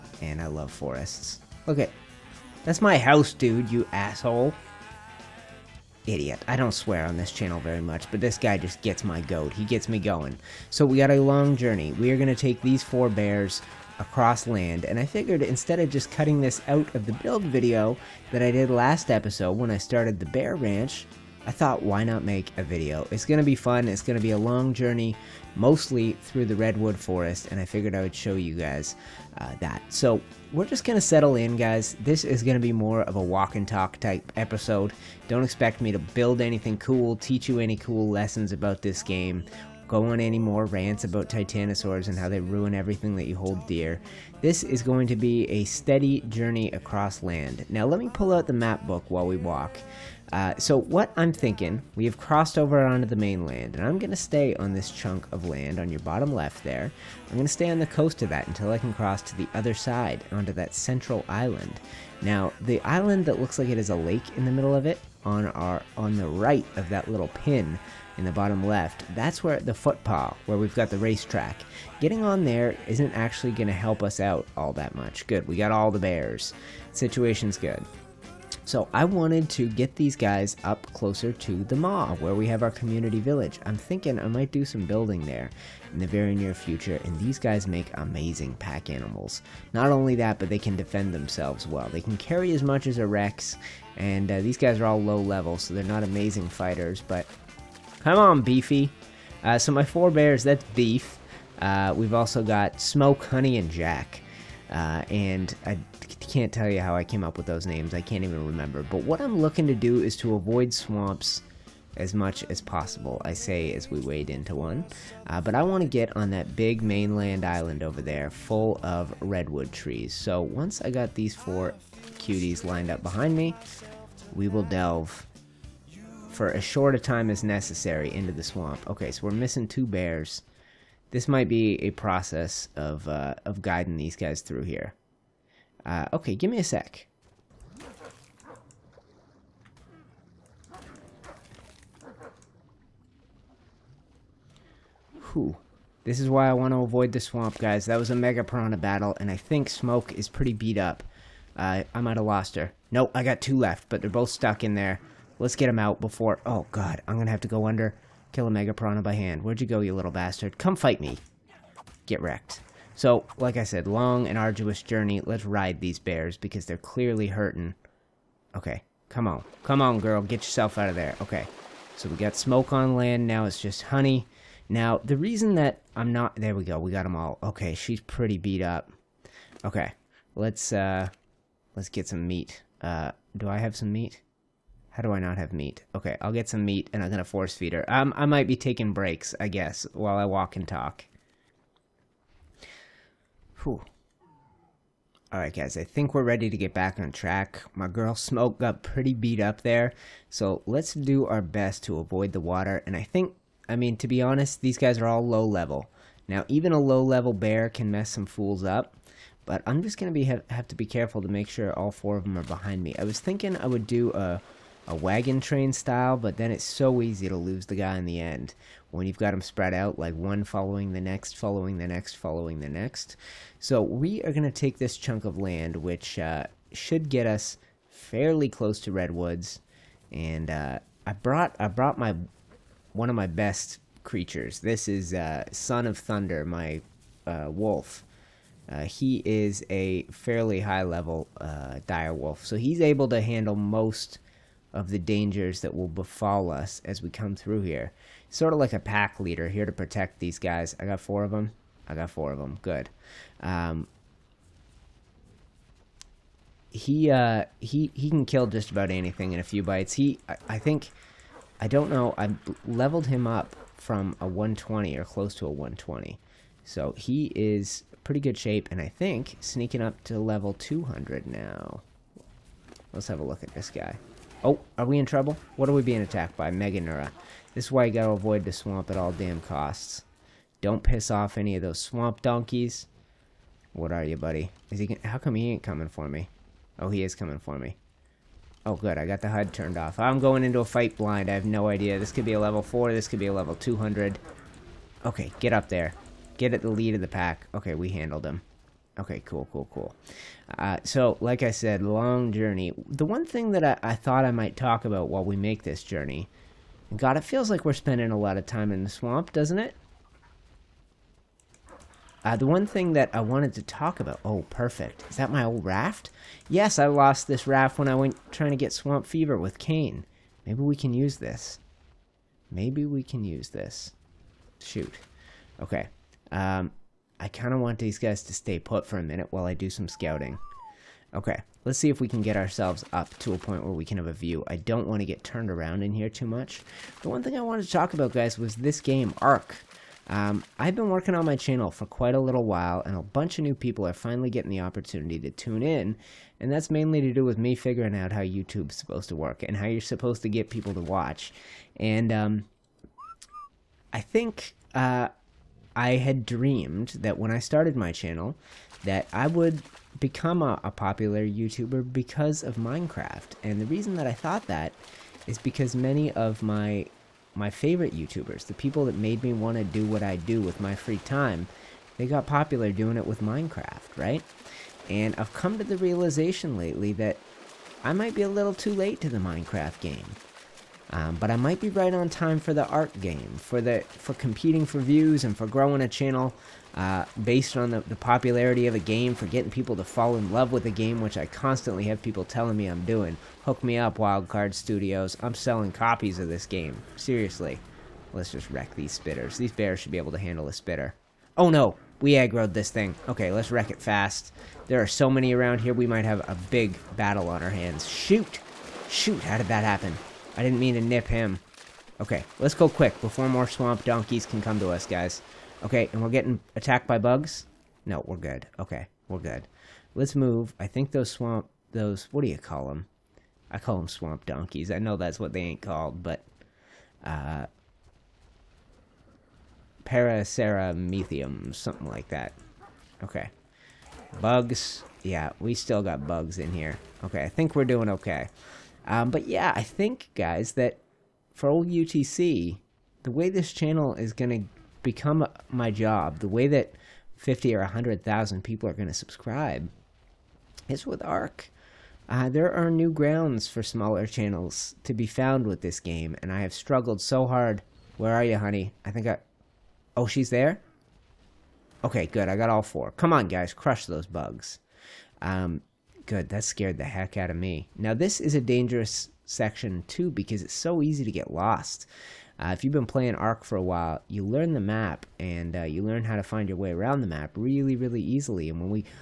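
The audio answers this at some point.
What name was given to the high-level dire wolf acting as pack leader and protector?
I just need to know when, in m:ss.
3:55.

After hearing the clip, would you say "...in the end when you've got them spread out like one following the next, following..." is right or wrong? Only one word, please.
right.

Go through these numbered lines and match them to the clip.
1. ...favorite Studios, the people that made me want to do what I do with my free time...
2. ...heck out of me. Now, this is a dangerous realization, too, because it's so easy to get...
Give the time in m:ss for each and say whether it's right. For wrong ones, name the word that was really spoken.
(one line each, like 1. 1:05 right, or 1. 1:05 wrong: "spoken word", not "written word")
1. 6:07 wrong: "YouTubers", not "Studios"
2. 7:46 wrong: "section", not "realization".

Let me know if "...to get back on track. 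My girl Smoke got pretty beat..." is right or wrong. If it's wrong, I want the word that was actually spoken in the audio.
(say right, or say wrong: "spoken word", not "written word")
right.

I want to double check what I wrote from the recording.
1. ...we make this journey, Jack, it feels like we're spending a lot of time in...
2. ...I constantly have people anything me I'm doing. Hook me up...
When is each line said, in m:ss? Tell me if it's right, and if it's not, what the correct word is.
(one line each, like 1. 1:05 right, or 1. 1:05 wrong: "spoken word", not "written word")
1. 5:05 wrong: "God", not "Jack"
2. 6:31 wrong: "telling", not "anything".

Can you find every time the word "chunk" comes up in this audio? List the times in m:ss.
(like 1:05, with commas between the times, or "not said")
0:54, 3:44.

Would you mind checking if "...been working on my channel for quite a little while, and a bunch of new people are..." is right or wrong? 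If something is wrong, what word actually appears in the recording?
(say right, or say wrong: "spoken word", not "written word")
right.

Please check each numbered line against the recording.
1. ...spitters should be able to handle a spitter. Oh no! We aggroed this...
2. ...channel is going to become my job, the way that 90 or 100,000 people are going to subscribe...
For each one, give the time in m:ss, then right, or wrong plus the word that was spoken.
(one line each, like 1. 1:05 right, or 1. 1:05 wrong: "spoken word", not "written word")
1. 6:39 wrong: "bears", not "spitters"
2. 7:23 wrong: "50", not "90".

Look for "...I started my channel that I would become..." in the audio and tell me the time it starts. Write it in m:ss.
5:57.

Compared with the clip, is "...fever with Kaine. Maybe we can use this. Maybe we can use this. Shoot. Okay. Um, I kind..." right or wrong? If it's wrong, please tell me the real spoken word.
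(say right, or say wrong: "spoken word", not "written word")
right.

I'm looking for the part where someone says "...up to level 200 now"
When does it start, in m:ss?
4:29.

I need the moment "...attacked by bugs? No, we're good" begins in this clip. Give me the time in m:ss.
6:56.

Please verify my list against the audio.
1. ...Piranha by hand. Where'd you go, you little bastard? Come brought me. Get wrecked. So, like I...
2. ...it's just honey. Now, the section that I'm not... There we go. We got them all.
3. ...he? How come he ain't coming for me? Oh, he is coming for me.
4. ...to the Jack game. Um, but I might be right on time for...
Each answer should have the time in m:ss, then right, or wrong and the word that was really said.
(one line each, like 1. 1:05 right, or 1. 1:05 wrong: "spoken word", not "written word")
1. 2:38 wrong: "fight", not "brought"
2. 2:53 wrong: "reason", not "section"
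3. 4:44 right
4. 6:19 wrong: "Minecraft", not "Jack".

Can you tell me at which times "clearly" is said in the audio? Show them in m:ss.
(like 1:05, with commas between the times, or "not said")
2:46.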